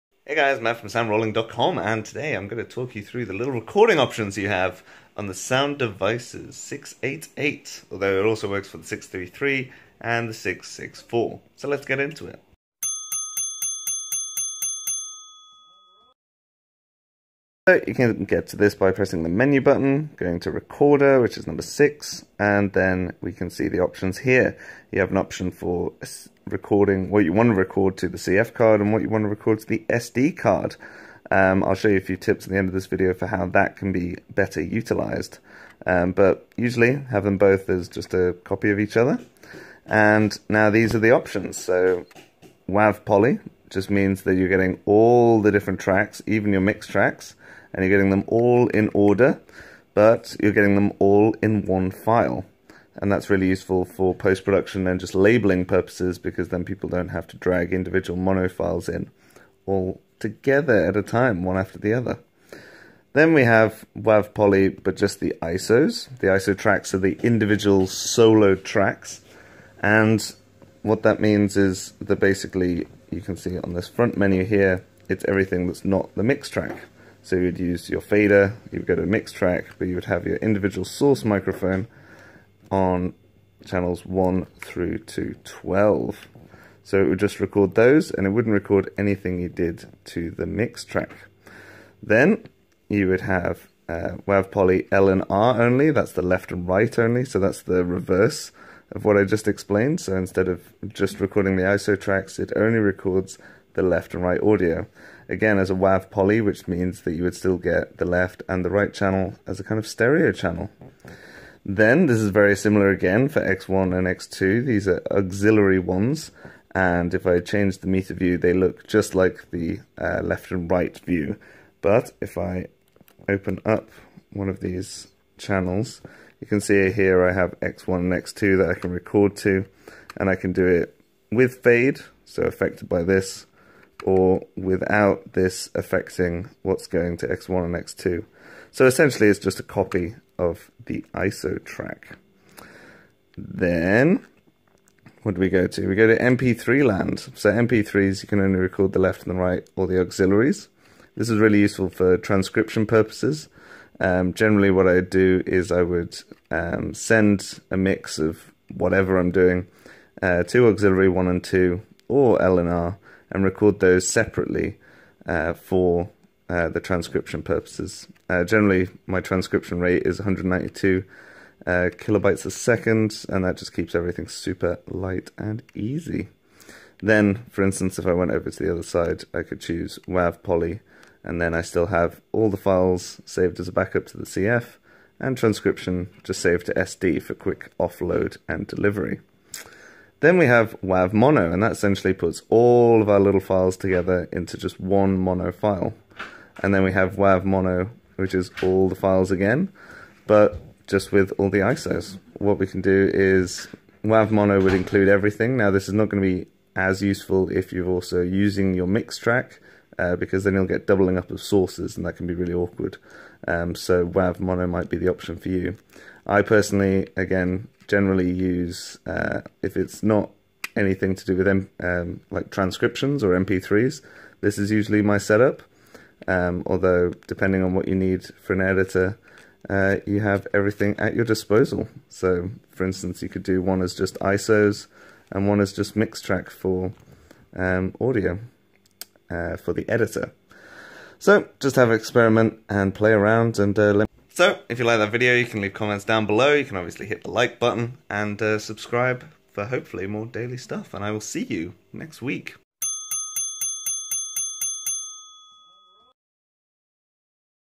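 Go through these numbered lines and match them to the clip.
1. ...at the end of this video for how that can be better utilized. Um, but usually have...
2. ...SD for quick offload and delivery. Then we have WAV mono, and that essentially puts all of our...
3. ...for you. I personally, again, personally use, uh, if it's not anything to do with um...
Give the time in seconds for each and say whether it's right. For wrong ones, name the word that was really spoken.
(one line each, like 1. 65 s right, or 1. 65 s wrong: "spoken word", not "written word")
1. 32 s right
2. 186 s right
3. 215 s wrong: "generally", not "personally".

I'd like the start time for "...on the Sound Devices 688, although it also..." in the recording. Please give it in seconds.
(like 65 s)
5 s.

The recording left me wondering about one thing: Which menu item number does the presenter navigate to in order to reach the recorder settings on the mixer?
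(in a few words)
6.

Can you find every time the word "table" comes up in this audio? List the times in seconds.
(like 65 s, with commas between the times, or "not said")
not said.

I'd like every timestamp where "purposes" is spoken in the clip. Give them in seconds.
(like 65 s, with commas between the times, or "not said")
55 s, 152 s, 167 s.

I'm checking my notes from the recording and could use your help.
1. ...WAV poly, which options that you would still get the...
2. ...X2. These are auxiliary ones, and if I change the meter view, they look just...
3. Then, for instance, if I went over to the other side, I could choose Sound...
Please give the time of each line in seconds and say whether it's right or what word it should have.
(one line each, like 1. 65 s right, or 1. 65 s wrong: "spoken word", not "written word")
1. 105 s wrong: "means", not "options"
2. 114 s right
3. 177 s wrong: "WAV", not "Sound".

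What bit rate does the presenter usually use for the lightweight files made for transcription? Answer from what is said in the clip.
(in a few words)
192 kilobytes a second.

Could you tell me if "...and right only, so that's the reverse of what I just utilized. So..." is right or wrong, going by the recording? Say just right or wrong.
wrong.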